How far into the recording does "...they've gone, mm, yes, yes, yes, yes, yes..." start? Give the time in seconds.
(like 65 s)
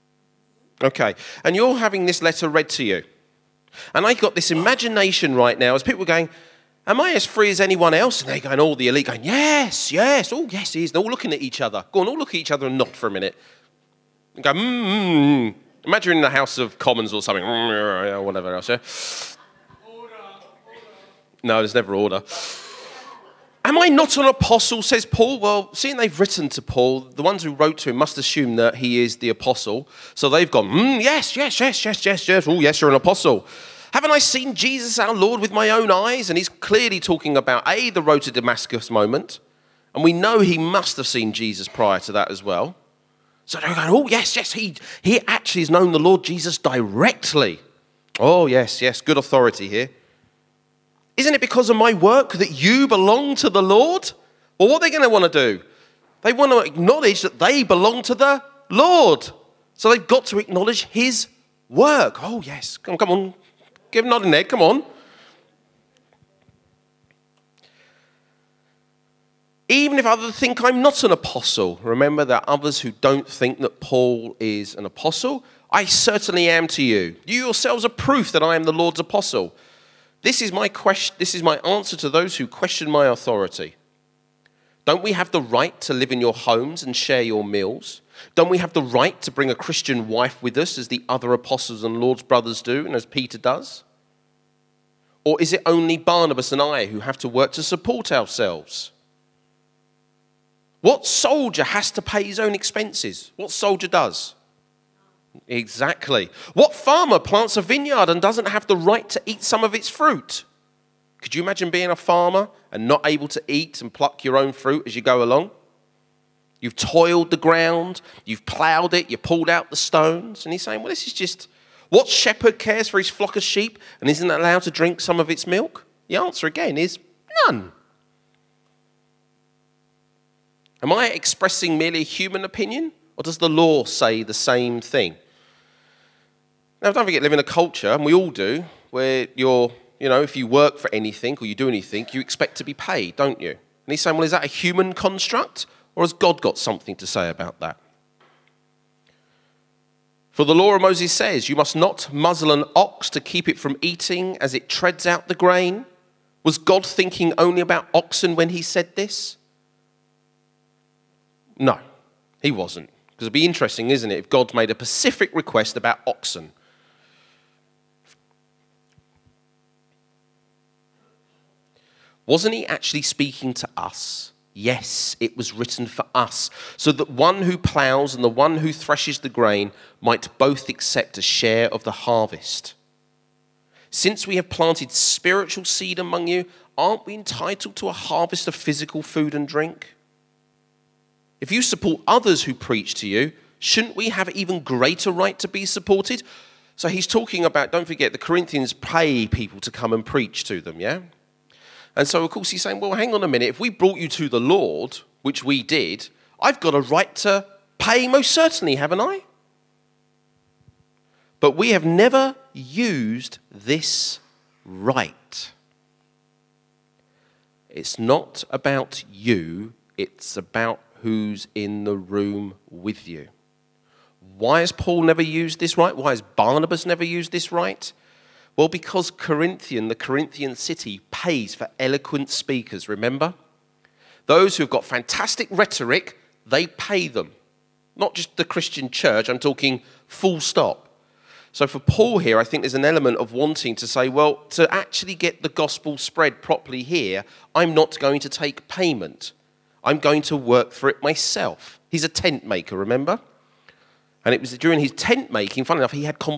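30 s.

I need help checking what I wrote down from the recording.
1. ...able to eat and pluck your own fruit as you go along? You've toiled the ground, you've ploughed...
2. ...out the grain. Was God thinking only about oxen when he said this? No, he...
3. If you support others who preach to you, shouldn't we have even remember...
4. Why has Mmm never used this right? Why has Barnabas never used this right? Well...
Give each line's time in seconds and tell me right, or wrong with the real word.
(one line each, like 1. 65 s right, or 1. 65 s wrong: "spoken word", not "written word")
1. 113 s right
2. 155 s right
3. 191 s wrong: "greater", not "remember"
4. 224 s wrong: "Paul", not "Mmm".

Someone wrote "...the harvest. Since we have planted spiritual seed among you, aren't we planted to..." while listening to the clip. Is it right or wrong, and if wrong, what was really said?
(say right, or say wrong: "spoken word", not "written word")
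wrong: "entitled", not "planted".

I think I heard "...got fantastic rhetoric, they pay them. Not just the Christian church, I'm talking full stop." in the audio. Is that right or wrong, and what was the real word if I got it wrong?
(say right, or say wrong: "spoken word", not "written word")
right.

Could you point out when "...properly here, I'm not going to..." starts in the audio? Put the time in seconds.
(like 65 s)
246 s.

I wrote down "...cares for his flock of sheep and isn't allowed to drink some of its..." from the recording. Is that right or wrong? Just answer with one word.
right.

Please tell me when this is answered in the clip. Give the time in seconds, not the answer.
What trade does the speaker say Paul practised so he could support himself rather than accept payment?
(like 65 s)
252 s.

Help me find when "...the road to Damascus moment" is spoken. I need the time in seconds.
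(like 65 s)
37 s.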